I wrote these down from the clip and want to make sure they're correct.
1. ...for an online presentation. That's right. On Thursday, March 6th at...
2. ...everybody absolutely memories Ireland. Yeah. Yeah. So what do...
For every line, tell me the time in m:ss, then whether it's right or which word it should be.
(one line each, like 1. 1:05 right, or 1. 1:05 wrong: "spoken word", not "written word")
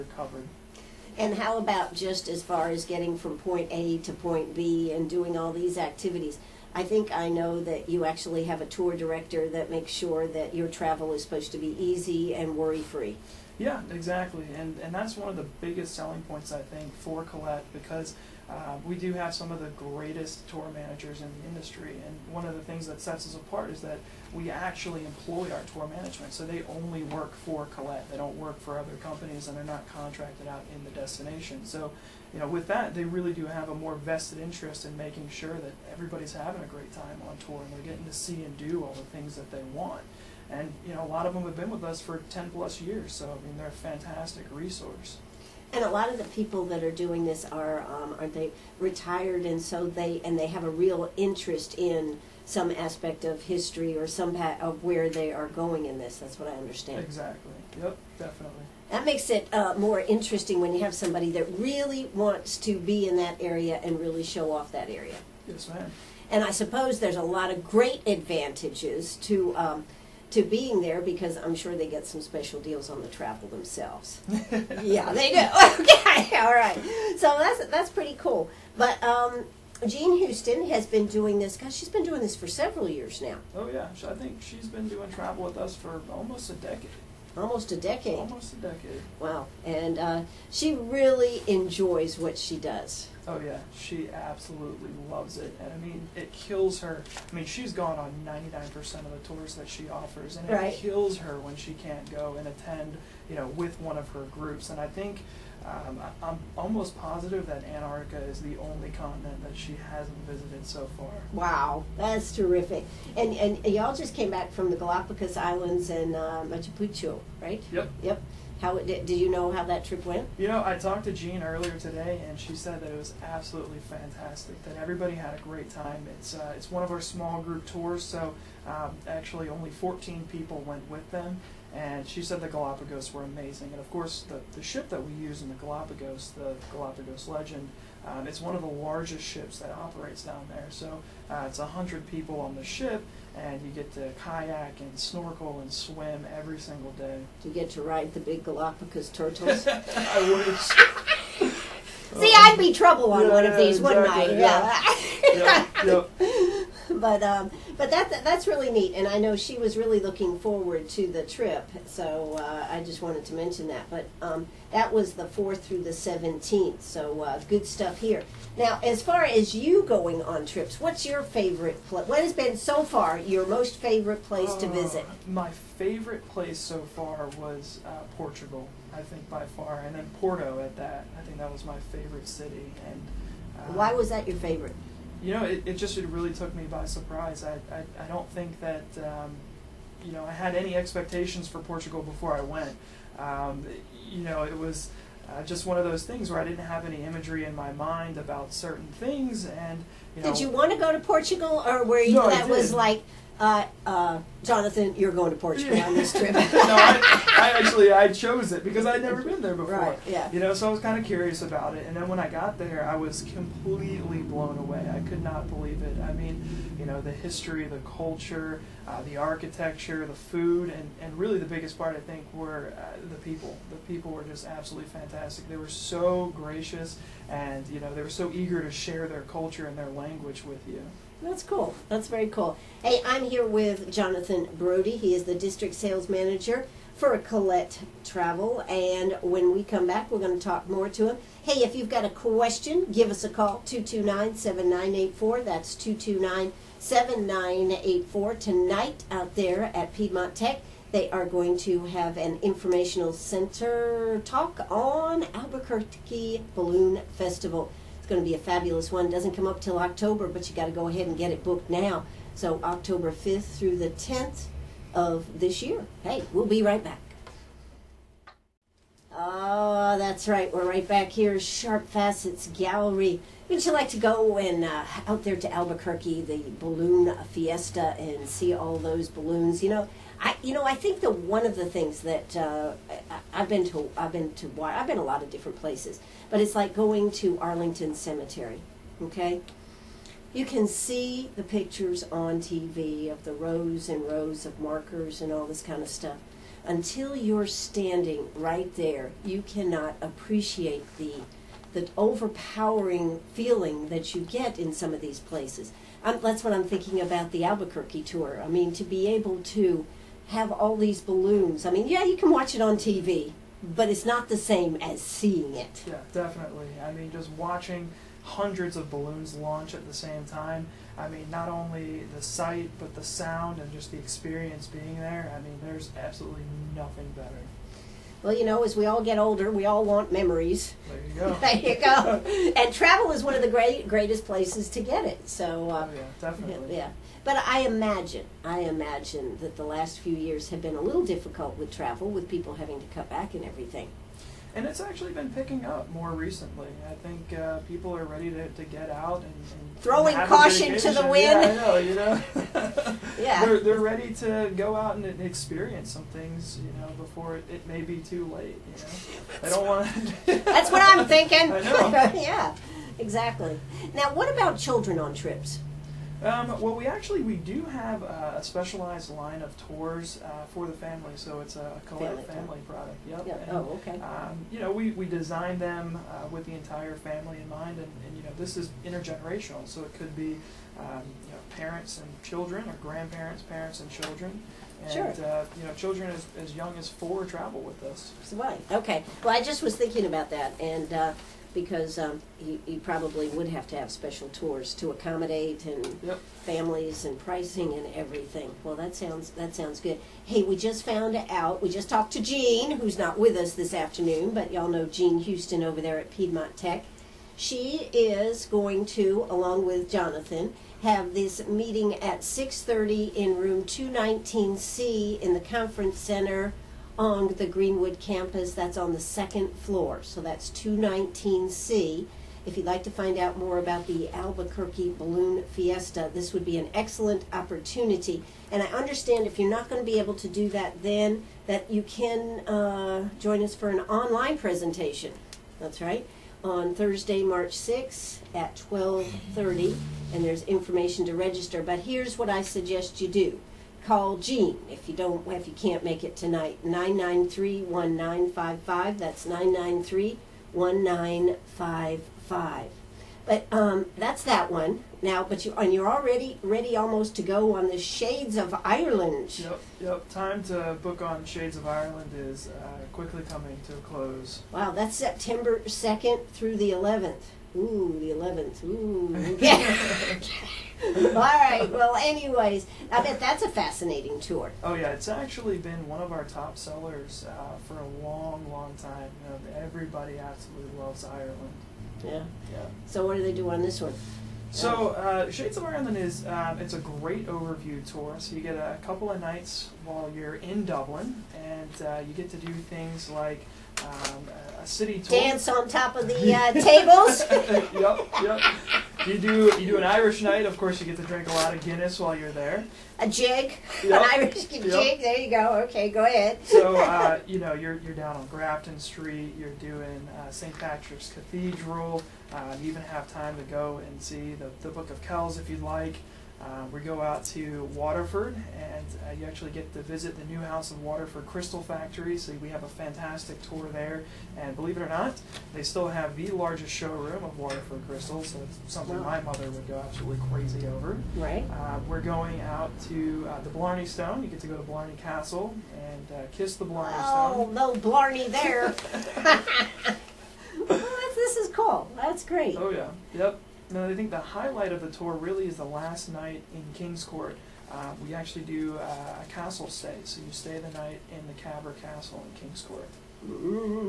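1. 7:13 right
2. 7:59 wrong: "loves", not "memories".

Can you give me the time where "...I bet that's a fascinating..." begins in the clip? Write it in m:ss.
7:52.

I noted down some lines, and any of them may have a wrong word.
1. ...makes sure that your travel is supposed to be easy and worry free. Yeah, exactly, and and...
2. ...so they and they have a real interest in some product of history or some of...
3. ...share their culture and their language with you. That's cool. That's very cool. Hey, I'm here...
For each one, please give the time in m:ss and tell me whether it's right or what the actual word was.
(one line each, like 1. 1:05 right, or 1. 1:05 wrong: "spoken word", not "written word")
1. 0:09 right
2. 0:49 wrong: "aspect", not "product"
3. 3:48 right.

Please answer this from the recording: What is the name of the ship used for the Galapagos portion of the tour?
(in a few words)
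Galapagos Legend.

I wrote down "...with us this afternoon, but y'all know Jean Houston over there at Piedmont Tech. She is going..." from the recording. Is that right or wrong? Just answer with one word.
right.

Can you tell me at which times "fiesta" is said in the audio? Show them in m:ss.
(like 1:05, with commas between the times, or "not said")
4:37, 7:05.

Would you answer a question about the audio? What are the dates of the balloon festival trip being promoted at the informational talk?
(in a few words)
October 5th through 10th.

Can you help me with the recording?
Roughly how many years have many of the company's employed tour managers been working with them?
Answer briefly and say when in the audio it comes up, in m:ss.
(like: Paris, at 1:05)
10 plus years, at 0:42.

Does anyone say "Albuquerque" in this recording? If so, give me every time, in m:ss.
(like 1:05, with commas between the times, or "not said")
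4:15, 4:35, 5:07, 7:04.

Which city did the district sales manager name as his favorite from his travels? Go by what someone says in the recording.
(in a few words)
Porto.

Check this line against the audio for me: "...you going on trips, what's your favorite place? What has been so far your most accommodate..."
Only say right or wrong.
wrong.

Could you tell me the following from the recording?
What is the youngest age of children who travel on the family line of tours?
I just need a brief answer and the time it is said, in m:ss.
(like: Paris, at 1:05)
4, at 6:26.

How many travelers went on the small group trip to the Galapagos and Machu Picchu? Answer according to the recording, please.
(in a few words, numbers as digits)
14.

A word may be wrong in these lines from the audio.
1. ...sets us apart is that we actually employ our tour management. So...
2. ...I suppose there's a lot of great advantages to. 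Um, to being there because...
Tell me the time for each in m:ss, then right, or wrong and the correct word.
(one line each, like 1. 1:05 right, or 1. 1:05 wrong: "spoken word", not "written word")
1. 0:23 right
2. 1:06 right.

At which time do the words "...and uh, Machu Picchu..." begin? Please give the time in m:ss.
1:55.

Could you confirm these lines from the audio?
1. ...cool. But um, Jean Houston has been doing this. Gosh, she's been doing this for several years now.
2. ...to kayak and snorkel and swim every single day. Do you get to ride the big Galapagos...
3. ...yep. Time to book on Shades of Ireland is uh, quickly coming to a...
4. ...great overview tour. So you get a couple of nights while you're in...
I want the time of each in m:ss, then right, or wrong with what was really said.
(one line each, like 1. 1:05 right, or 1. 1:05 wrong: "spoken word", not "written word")
1. 1:18 right
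2. 2:23 right
3. 7:39 right
4. 8:06 right.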